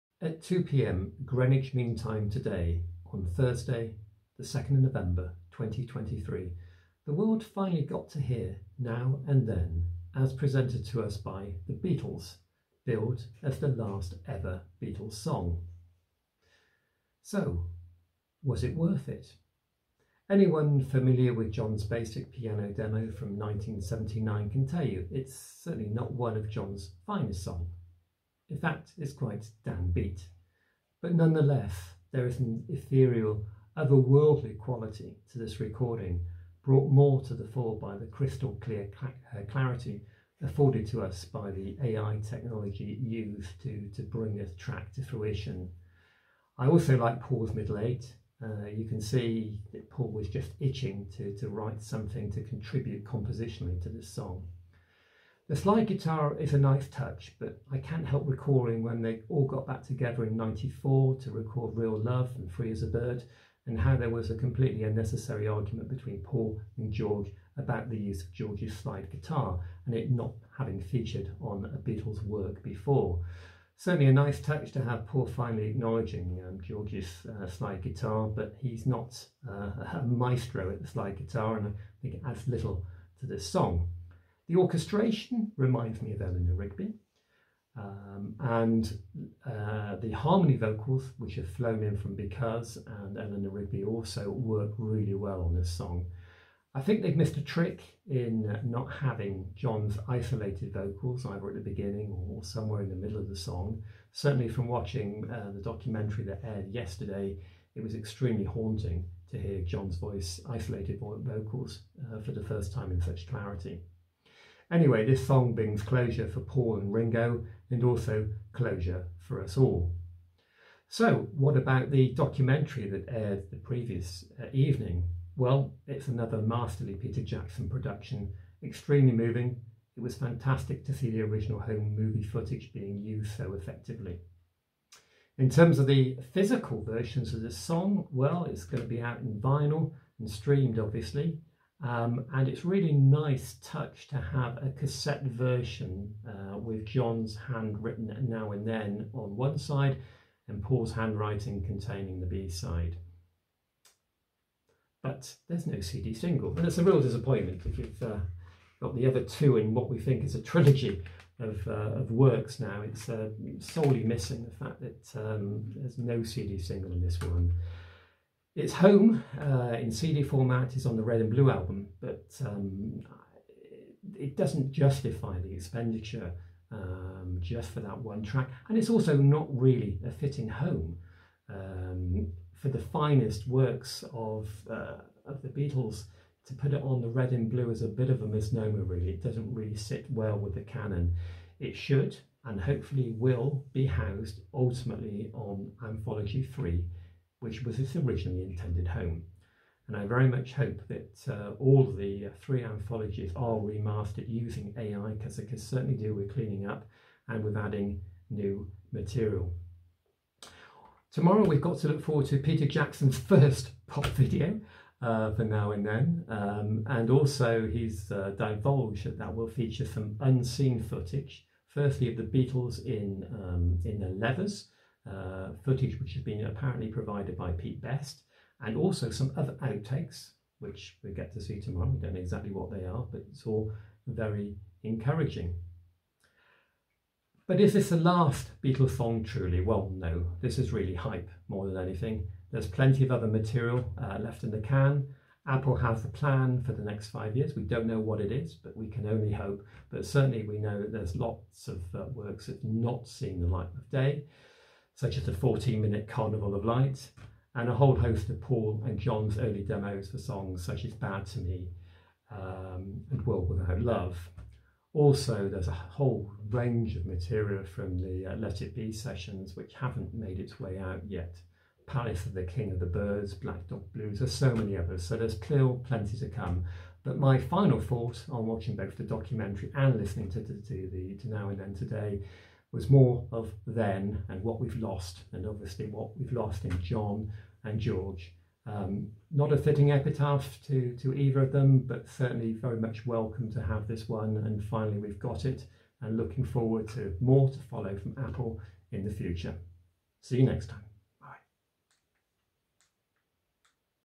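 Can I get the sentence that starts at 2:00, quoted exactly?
So, what about the documentary that aired the previous uh, evening?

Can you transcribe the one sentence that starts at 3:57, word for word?
But is this the last Beatles song truly?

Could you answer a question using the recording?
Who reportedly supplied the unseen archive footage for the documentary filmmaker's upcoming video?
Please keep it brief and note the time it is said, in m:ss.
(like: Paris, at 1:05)
Pete Best, at 3:47.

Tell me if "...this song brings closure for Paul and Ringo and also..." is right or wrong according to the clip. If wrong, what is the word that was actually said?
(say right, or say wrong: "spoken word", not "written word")
right.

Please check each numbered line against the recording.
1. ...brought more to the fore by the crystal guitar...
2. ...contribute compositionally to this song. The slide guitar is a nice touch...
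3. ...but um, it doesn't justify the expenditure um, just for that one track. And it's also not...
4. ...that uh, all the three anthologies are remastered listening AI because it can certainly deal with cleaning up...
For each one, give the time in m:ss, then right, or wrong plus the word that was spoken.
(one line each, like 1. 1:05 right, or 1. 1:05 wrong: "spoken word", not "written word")
1. 0:36 wrong: "clear", not "guitar"
2. 0:52 right
3. 2:52 right
4. 3:20 wrong: "using", not "listening".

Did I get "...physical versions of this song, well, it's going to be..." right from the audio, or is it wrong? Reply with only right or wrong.
right.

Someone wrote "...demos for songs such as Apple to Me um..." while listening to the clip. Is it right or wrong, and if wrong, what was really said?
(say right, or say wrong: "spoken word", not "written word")
wrong: "Bad", not "Apple".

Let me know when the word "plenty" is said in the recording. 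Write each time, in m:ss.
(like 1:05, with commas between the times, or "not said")
4:02, 4:35.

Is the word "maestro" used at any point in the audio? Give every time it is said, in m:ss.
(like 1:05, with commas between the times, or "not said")
1:20.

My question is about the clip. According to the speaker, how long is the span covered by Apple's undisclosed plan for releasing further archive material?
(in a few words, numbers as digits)
5 years.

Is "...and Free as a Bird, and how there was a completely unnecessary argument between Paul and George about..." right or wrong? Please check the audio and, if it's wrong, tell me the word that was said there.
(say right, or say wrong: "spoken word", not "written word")
right.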